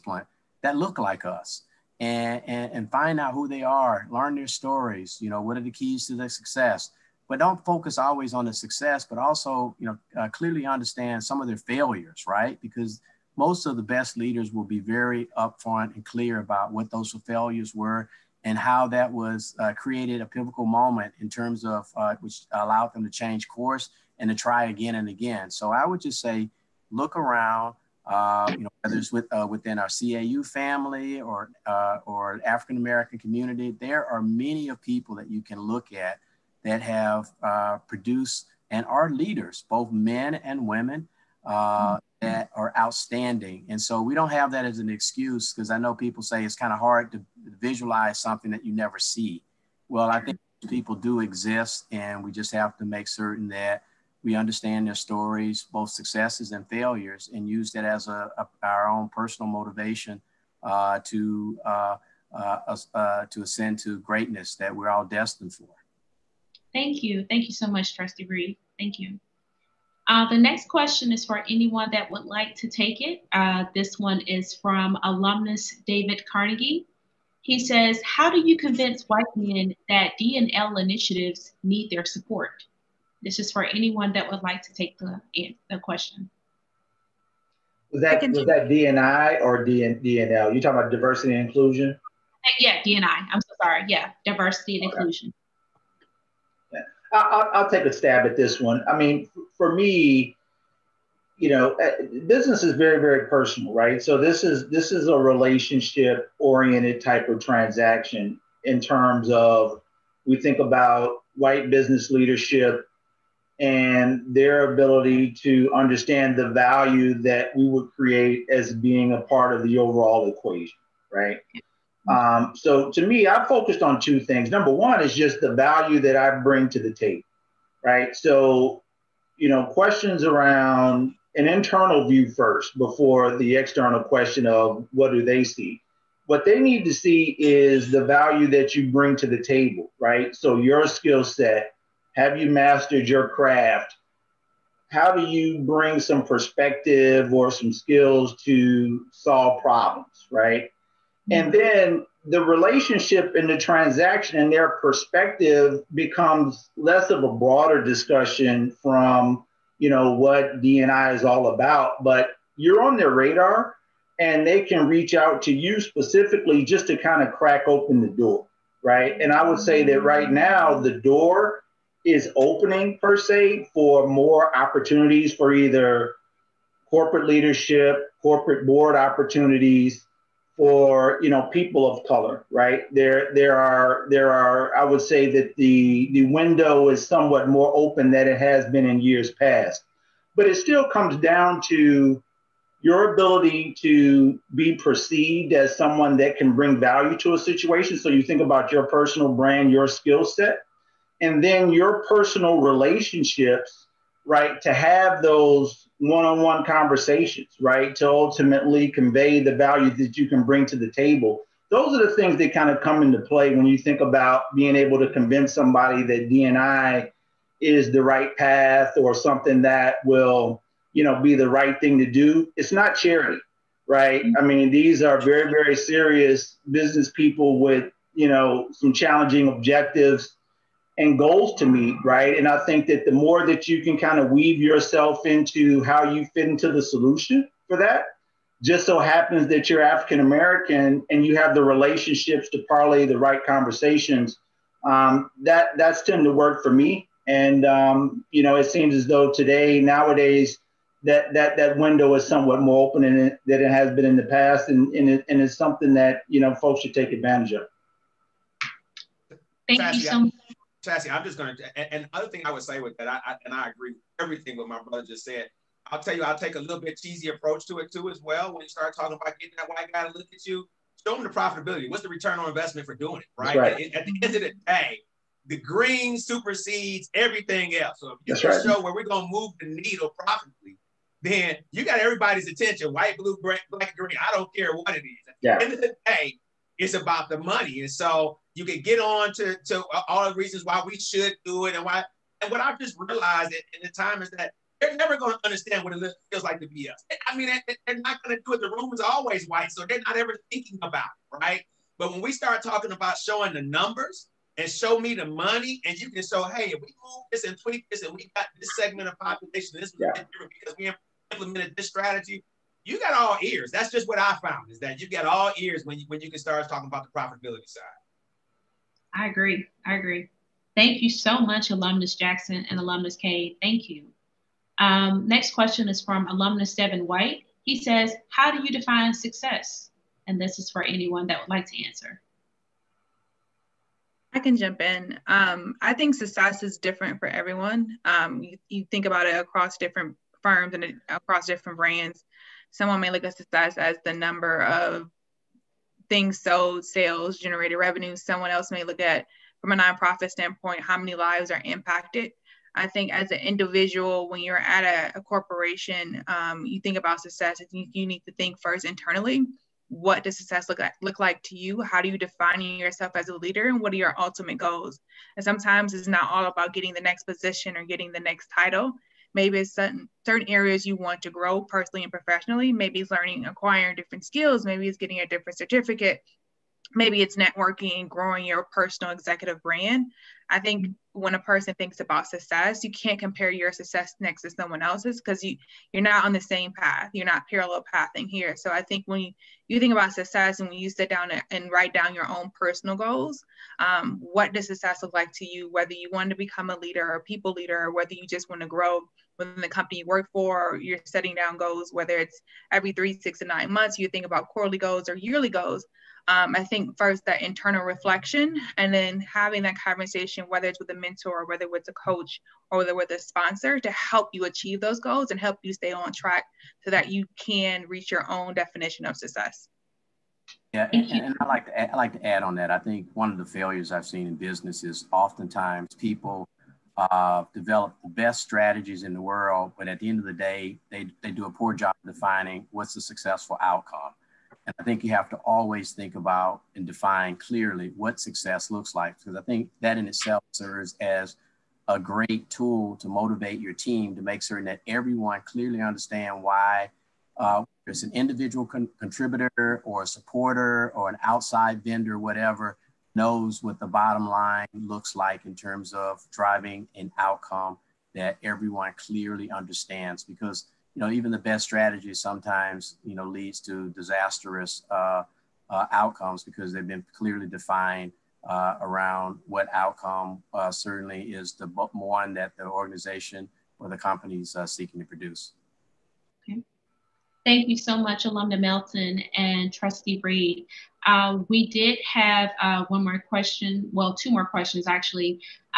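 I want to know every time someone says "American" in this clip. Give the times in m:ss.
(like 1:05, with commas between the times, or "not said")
0:32, 4:00.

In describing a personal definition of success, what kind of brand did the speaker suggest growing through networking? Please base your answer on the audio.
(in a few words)
Personal executive brand.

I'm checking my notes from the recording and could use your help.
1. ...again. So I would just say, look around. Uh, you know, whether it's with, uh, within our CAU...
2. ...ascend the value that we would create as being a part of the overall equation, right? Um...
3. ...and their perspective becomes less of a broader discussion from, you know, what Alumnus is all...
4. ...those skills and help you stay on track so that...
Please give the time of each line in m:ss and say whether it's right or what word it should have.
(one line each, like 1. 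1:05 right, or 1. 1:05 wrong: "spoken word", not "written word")
1. 0:25 right
2. 1:55 wrong: "understand", not "ascend"
3. 2:34 wrong: "DNI", not "Alumnus"
4. 6:54 wrong: "goals", not "skills".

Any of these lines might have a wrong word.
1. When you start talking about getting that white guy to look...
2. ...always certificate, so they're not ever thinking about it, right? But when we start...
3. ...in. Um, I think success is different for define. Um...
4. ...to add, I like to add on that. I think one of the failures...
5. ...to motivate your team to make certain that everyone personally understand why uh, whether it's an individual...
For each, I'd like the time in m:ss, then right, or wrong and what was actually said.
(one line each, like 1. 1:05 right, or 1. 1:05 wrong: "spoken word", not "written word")
1. 4:28 right
2. 4:59 wrong: "white", not "certificate"
3. 5:34 wrong: "everyone", not "define"
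4. 7:01 right
5. 7:22 wrong: "clearly", not "personally".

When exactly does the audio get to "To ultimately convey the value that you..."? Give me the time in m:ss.
3:27.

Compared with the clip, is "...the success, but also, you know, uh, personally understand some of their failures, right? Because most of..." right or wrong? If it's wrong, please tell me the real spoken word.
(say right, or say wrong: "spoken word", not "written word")
wrong: "clearly", not "personally".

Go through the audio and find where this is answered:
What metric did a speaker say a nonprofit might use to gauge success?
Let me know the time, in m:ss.
5:50.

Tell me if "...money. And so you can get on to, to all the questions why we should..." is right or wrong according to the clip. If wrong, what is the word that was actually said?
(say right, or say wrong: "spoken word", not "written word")
wrong: "reasons", not "questions".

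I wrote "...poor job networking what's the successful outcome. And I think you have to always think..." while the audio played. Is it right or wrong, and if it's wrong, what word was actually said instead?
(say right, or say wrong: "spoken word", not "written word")
wrong: "defining", not "networking".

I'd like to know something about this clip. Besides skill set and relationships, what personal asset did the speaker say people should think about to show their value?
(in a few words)
Personal brand.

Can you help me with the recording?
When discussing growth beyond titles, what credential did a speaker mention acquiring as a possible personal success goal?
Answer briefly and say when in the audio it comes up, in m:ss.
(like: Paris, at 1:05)
A different certificate, at 6:14.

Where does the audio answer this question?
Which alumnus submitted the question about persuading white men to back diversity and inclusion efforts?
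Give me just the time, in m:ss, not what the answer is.
1:15.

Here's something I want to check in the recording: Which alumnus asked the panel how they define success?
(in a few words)
Devin White.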